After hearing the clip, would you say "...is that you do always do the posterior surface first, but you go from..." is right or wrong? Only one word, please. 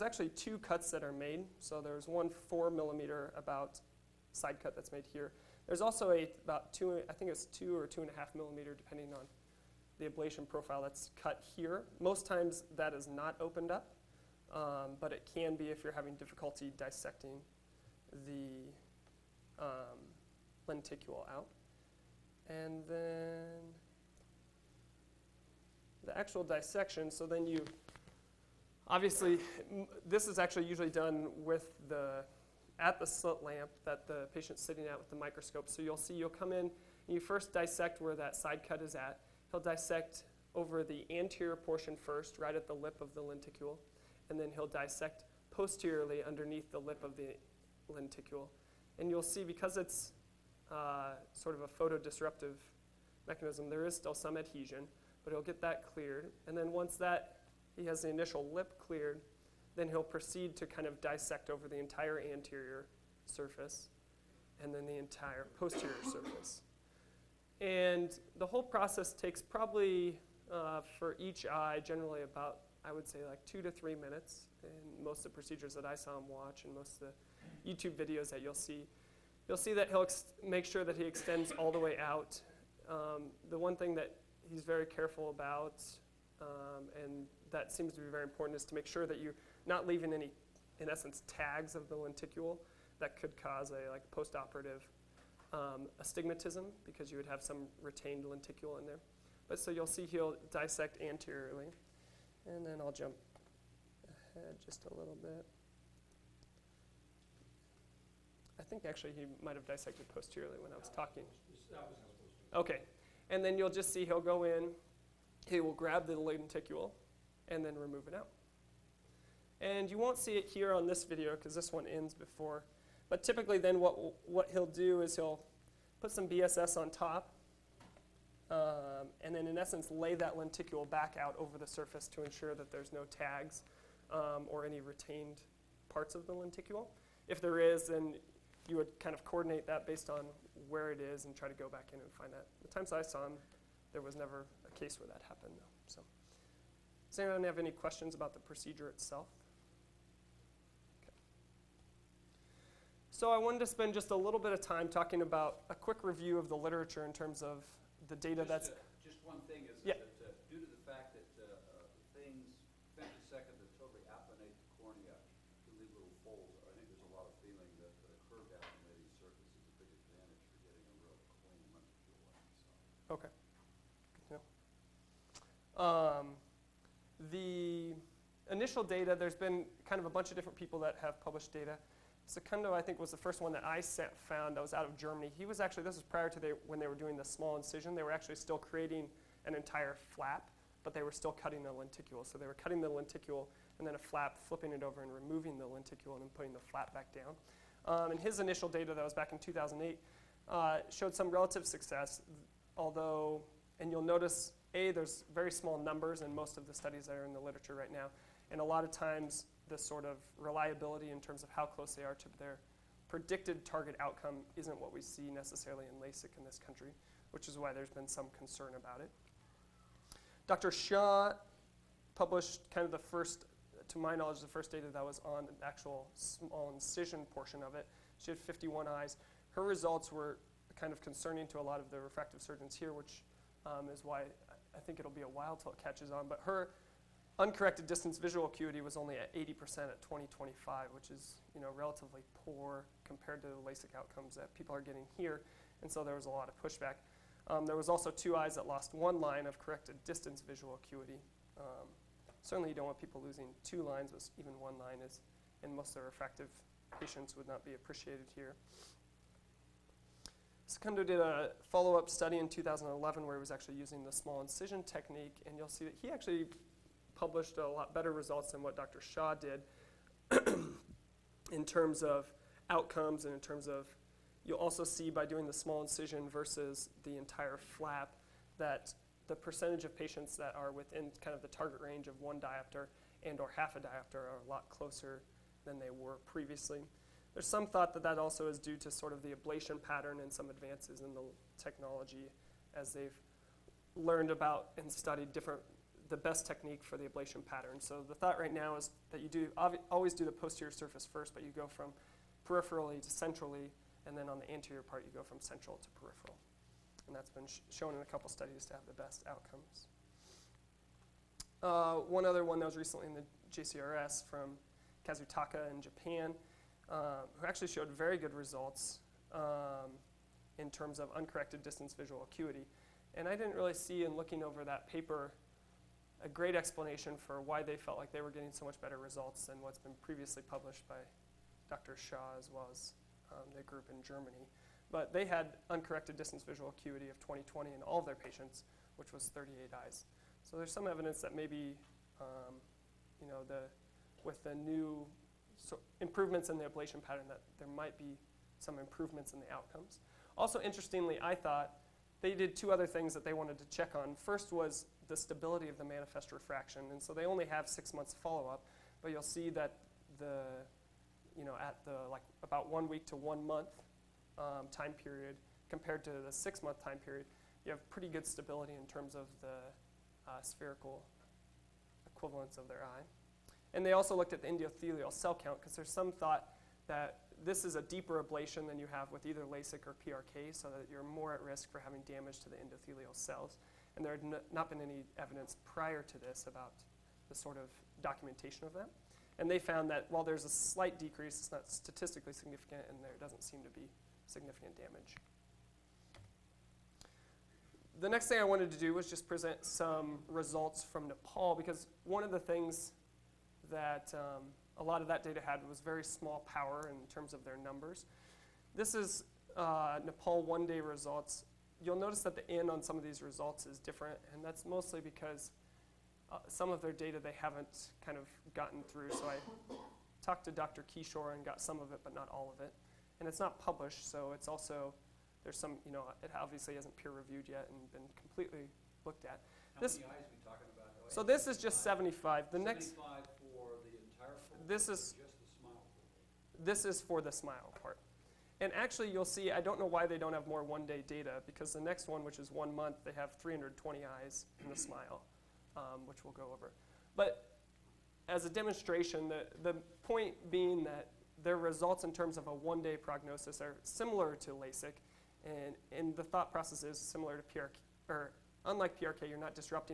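right.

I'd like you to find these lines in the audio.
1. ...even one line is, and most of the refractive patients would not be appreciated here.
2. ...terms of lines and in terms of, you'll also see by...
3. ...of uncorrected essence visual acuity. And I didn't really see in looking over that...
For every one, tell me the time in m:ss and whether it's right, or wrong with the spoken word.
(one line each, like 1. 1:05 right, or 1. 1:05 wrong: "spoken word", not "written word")
1. 4:14 right
2. 4:31 wrong: "outcomes", not "lines"
3. 5:20 wrong: "distance", not "essence".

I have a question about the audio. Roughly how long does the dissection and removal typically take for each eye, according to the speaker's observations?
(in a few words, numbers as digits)
2 to 3 minutes.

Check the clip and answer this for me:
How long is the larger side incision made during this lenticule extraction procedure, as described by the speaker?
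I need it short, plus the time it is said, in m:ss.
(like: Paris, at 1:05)
4 millimeter, at 0:02.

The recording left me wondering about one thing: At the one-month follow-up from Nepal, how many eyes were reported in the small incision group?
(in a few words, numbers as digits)
320.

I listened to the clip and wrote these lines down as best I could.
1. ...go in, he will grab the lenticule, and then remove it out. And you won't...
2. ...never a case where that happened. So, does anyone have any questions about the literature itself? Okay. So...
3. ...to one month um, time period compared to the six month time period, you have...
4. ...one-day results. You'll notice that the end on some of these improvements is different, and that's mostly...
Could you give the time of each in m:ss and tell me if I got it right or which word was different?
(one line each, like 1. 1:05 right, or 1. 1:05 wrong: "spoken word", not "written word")
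1. 1:54 right
2. 2:24 wrong: "procedure", not "literature"
3. 6:03 right
4. 6:50 wrong: "results", not "improvements".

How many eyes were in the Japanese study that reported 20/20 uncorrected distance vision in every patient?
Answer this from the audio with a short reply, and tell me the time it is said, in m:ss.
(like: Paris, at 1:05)
38, at 5:39.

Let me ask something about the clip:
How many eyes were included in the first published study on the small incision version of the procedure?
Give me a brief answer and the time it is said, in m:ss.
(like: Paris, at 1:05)
51, at 3:48.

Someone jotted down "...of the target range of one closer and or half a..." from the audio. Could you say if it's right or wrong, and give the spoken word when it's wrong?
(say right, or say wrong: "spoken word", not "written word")
wrong: "diopter", not "closer".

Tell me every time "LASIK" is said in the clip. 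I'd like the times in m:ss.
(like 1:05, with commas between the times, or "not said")
3:36, 4:03, 6:19, 7:34.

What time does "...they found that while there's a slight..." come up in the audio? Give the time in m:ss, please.
6:29.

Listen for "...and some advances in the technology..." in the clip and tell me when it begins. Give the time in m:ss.
4:50.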